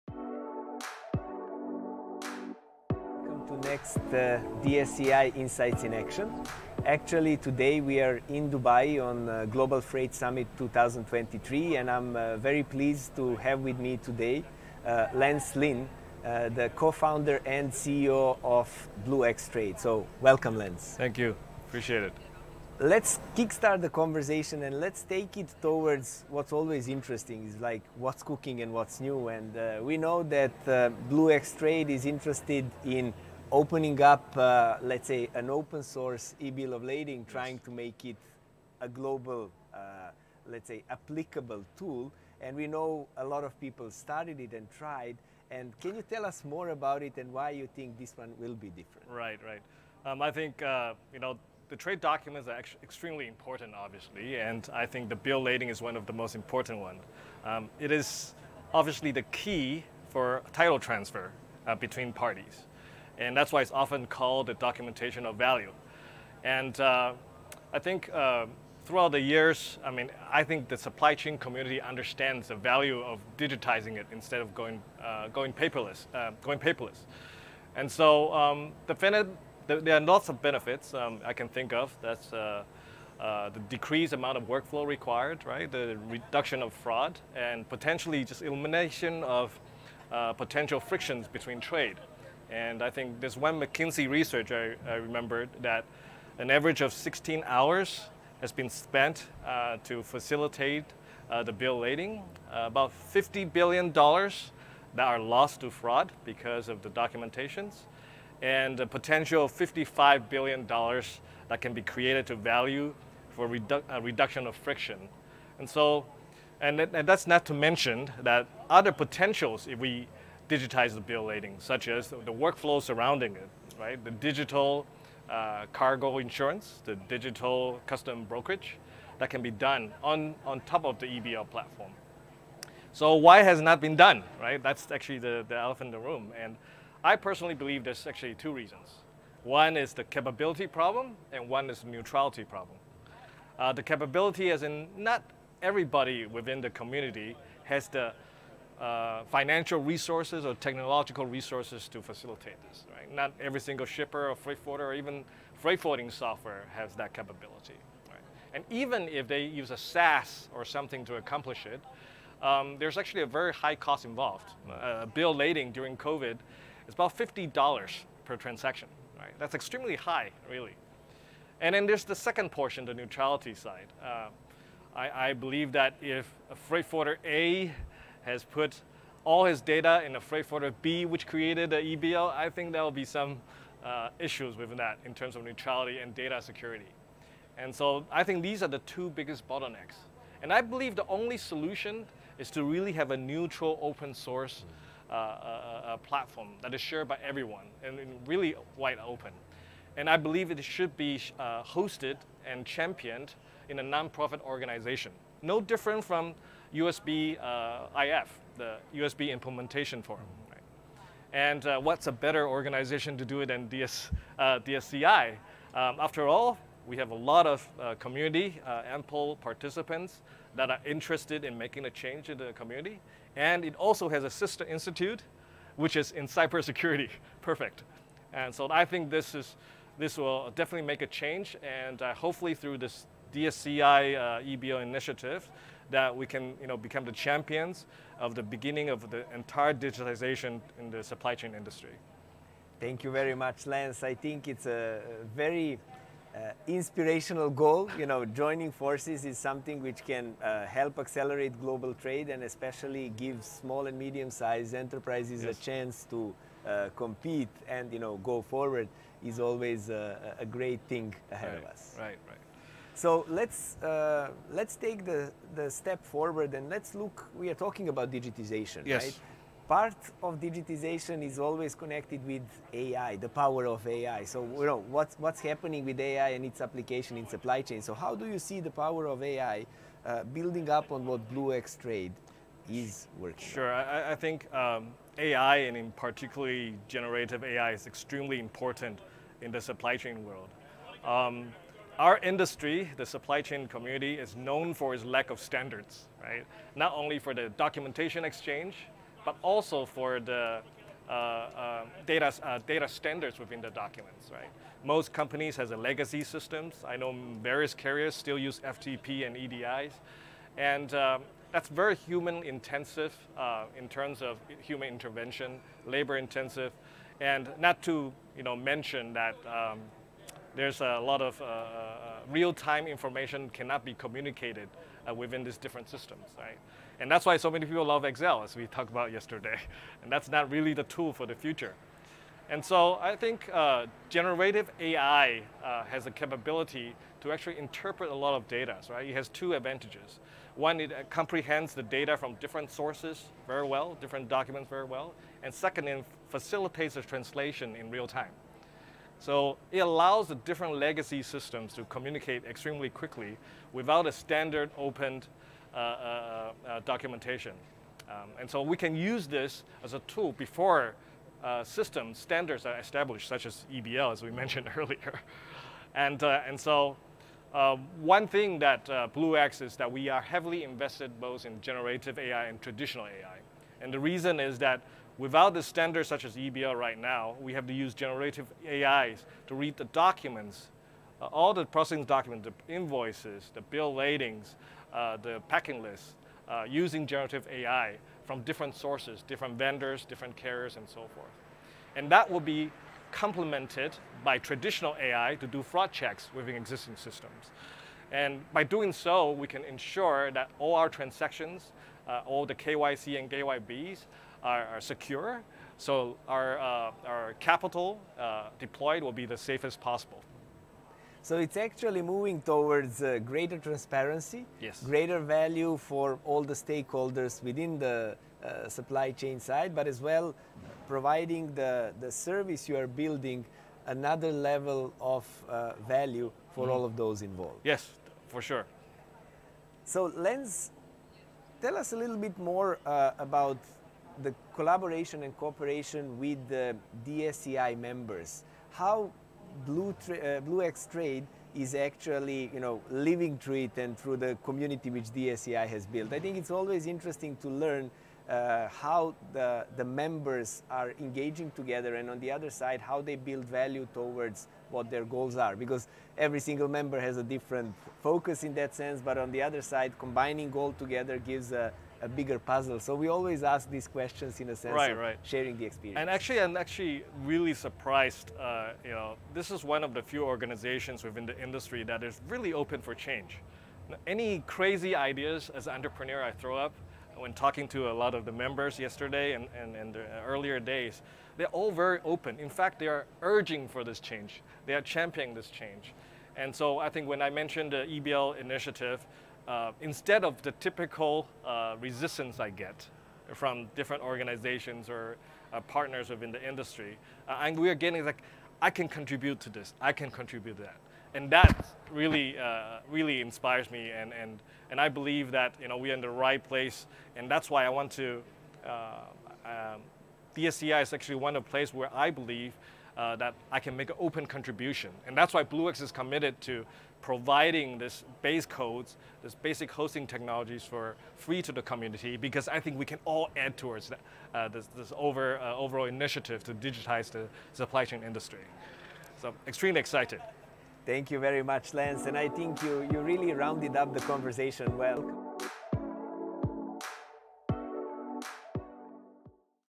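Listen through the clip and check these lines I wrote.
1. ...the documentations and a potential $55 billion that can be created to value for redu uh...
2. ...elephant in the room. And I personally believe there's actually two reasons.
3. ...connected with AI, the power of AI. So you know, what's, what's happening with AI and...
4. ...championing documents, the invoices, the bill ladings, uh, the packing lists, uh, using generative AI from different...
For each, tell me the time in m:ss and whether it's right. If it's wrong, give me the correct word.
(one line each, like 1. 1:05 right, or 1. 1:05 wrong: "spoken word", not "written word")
1. 1:46 right
2. 2:15 right
3. 4:31 right
4. 6:21 wrong: "processing", not "championing".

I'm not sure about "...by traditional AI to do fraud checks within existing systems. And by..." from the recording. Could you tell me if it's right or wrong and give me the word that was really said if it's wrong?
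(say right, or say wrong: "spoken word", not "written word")
right.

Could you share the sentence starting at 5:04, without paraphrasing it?
Most companies has a legacy systems.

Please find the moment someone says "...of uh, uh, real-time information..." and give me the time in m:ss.
5:21.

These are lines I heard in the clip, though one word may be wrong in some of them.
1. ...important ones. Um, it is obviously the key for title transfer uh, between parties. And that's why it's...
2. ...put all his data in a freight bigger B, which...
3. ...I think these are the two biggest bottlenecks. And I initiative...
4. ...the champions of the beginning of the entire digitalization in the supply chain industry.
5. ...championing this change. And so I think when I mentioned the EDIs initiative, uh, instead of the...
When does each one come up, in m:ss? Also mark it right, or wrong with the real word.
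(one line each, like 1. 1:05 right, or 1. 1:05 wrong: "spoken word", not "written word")
1. 0:56 right
2. 2:58 wrong: "forwarder", not "bigger"
3. 3:08 wrong: "believe", not "initiative"
4. 3:57 right
5. 8:04 wrong: "EBL", not "EDIs".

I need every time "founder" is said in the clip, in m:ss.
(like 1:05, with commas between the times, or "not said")
0:16.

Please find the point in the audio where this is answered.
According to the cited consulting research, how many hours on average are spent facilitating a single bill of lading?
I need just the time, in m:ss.
1:36.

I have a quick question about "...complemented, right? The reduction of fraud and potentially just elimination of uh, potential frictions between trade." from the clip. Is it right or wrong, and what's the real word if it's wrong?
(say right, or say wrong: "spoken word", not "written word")
wrong: "required", not "complemented".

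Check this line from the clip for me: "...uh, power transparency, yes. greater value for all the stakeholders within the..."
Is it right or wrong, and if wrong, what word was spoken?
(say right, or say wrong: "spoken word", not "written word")
wrong: "greater", not "power".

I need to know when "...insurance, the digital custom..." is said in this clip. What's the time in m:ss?
2:06.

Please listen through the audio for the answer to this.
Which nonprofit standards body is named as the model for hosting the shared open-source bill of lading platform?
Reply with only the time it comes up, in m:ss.
3:28.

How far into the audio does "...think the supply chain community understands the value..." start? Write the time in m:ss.
1:10.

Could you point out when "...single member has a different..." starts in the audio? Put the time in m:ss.
7:36.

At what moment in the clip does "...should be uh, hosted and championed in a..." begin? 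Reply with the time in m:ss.
3:20.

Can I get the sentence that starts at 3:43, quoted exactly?
And it also has a sister institute, which is in cybersecurity.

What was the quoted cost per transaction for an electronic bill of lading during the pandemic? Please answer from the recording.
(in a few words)
$50.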